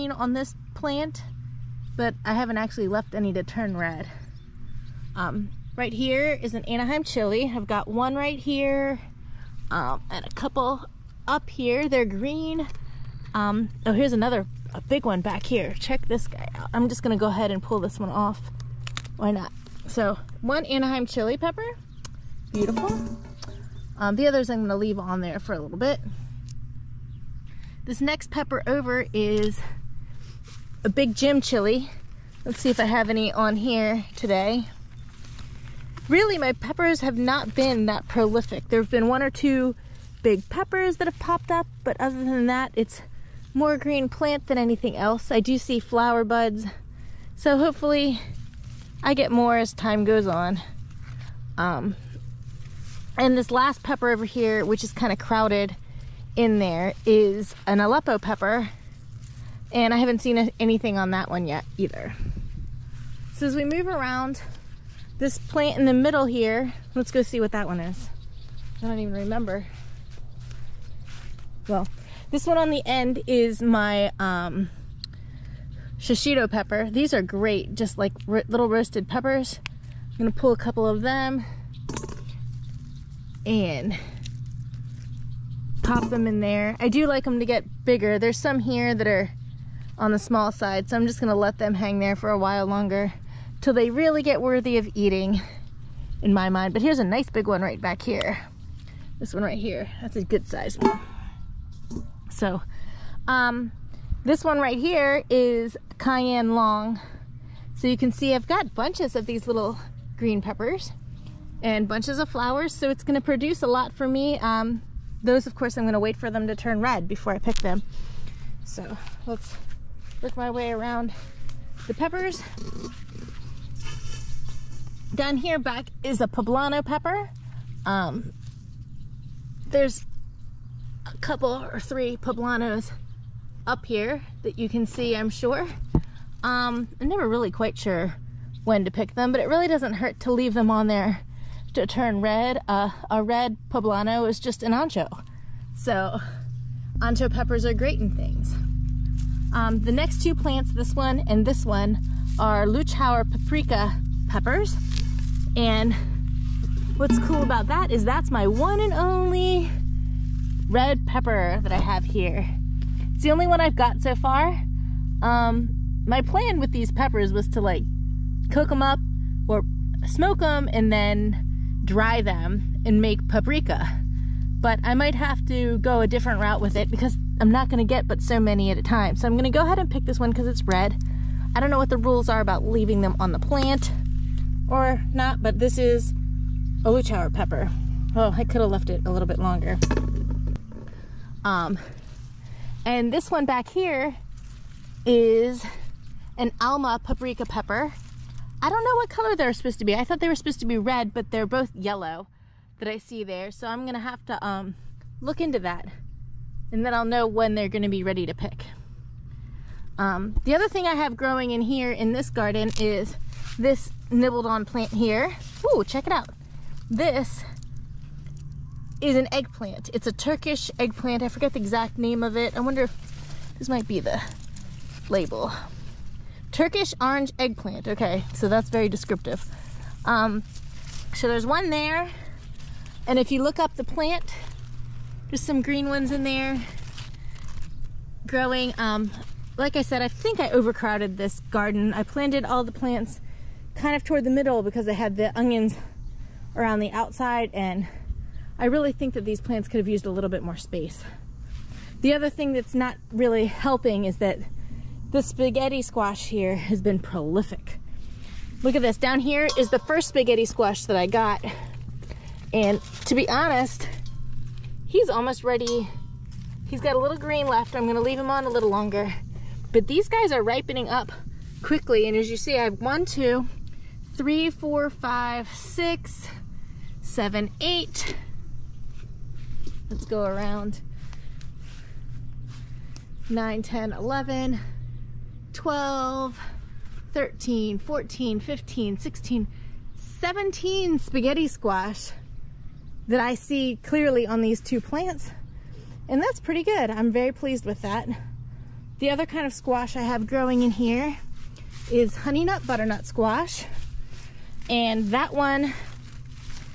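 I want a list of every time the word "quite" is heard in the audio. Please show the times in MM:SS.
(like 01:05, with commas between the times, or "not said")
02:17.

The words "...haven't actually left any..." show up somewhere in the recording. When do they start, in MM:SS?
00:02.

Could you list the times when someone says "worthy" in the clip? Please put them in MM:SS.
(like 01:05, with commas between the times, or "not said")
01:34.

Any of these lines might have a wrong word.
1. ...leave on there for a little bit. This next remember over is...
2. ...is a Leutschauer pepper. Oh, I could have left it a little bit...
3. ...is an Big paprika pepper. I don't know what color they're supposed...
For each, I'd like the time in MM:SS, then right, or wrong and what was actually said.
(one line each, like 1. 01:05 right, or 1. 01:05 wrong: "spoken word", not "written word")
1. 00:24 wrong: "pepper", not "remember"
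2. 03:05 right
3. 03:15 wrong: "Alma", not "Big".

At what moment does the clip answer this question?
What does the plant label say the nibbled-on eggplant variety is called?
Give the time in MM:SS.
03:46.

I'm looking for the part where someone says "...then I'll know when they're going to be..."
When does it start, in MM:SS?
03:26.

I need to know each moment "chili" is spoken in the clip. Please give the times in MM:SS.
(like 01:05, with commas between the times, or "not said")
00:07, 00:21, 00:31.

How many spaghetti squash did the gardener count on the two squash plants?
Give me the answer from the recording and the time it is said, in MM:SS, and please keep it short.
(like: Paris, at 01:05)
17, at 04:49.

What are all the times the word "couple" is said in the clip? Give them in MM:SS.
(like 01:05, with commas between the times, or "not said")
00:10, 01:20, 02:11.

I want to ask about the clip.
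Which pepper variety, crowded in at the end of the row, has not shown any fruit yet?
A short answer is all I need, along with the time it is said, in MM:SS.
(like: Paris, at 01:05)
Aleppo pepper, at 00:57.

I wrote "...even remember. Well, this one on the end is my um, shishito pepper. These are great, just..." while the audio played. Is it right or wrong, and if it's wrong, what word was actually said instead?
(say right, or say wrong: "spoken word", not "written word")
right.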